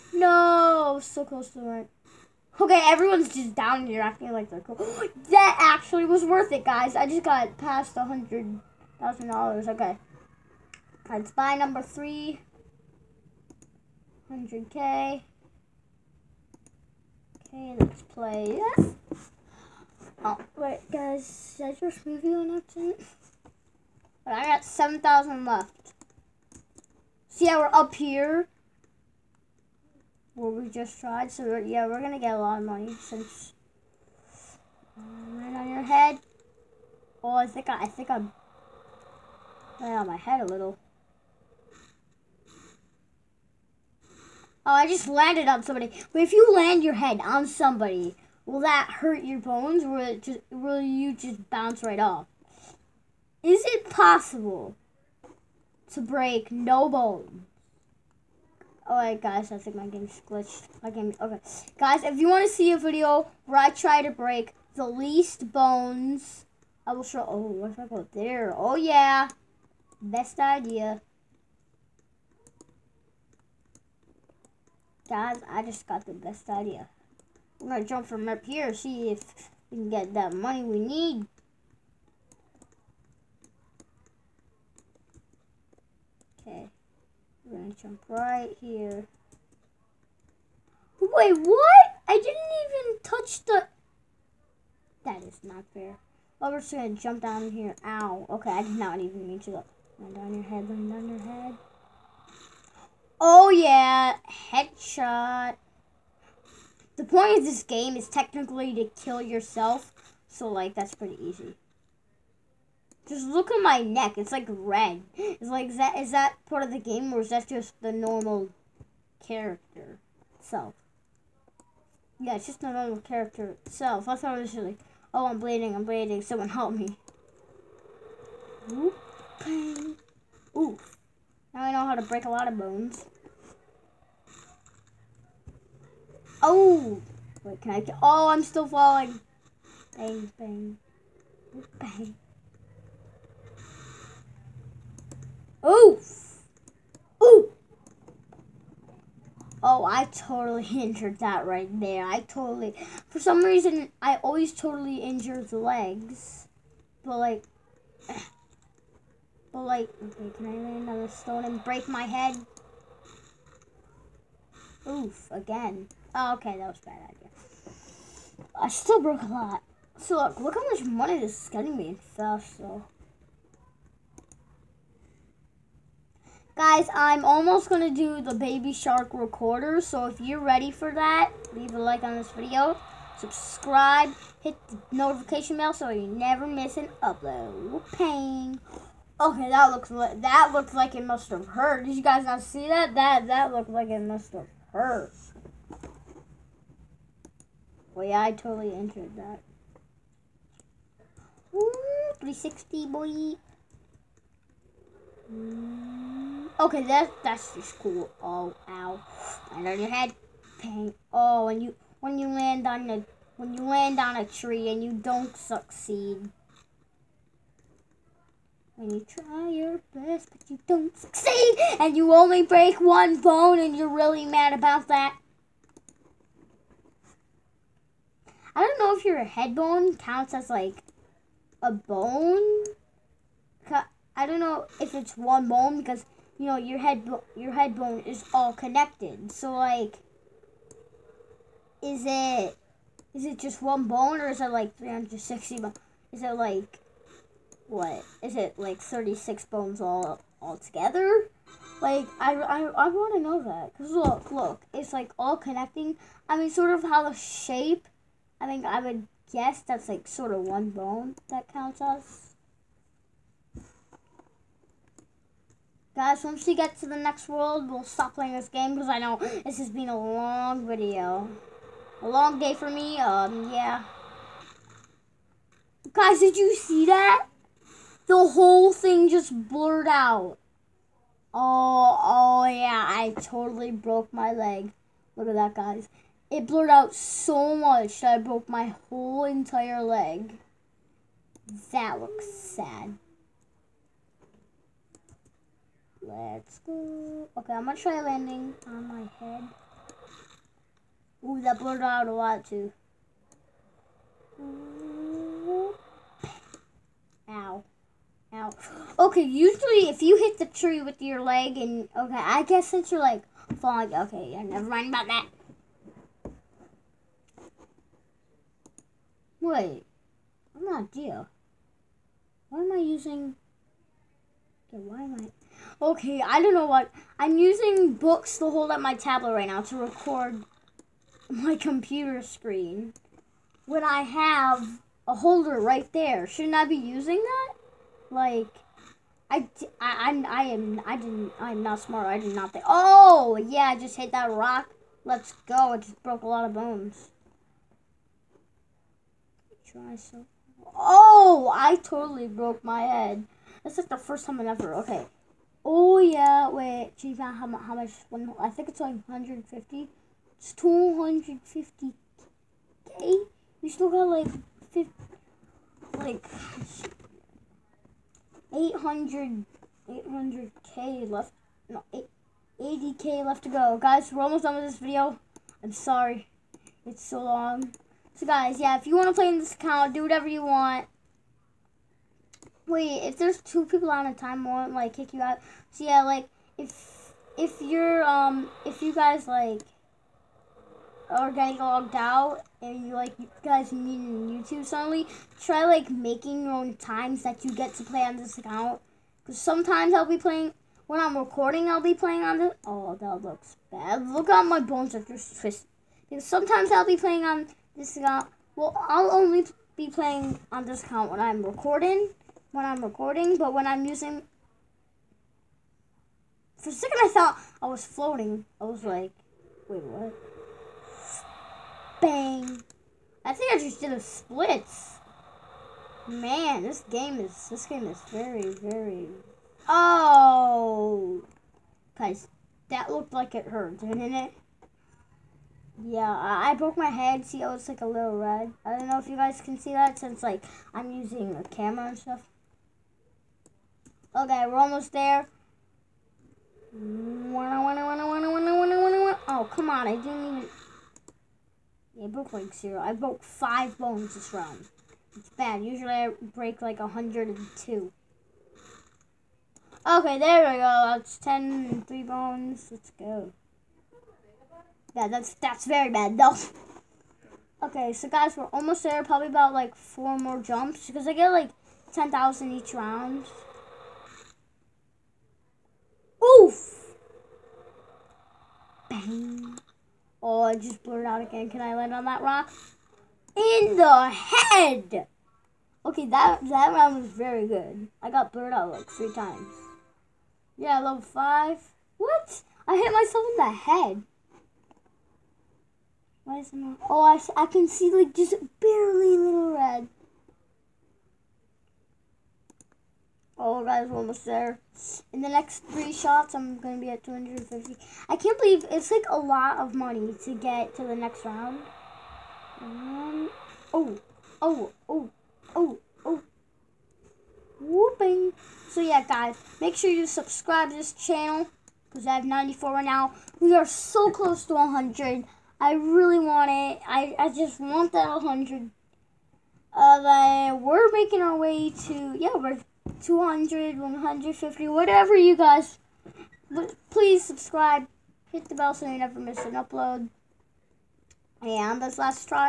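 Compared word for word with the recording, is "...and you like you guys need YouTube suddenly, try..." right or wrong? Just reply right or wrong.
right.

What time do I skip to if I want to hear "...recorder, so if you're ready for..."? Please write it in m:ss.
2:59.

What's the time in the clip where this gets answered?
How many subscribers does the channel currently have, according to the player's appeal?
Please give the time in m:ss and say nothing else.
8:42.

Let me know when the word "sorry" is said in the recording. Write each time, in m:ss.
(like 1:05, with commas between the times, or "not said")
6:15.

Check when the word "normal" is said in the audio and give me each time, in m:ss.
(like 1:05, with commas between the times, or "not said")
1:57, 2:02.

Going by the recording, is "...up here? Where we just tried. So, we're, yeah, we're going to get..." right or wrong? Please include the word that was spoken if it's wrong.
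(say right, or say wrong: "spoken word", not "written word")
right.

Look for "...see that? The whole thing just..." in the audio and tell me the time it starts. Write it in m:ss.
4:36.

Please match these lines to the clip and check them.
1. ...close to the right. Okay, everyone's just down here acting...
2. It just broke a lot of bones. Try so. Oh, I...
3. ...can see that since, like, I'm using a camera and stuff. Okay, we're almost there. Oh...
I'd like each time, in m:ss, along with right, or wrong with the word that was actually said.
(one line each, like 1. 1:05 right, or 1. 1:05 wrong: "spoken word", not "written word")
1. 0:01 right
2. 5:45 right
3. 7:19 right.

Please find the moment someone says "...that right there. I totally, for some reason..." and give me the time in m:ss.
2:31.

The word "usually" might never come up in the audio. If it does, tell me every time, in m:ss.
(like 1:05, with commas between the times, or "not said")
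5:09, 7:35.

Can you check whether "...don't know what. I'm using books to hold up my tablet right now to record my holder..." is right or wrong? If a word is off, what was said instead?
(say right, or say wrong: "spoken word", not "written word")
wrong: "computer", not "holder".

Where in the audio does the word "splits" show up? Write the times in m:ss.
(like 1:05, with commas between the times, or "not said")
7:04.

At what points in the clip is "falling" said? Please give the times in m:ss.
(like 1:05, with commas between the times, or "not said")
2:18, 5:13.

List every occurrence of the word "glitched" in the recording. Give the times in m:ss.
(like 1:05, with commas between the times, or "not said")
1:00.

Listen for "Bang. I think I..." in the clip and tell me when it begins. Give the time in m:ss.
7:02.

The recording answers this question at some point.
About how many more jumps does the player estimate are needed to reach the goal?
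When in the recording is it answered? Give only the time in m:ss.
7:49.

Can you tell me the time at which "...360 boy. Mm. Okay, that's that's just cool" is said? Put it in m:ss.
3:22.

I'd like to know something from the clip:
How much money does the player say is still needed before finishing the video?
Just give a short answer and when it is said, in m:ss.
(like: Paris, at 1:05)
80k, at 6:12.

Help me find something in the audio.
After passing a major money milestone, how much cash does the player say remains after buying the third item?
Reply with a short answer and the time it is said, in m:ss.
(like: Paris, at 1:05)
7,000, at 0:24.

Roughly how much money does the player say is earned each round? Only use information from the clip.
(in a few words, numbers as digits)
10,000.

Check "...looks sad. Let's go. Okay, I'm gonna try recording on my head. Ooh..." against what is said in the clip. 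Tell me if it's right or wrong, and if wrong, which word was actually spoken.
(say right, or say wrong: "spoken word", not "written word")
wrong: "landing", not "recording".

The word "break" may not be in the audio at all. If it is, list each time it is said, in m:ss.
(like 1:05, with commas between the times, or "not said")
0:56, 1:04, 2:12, 2:41, 3:42, 7:36.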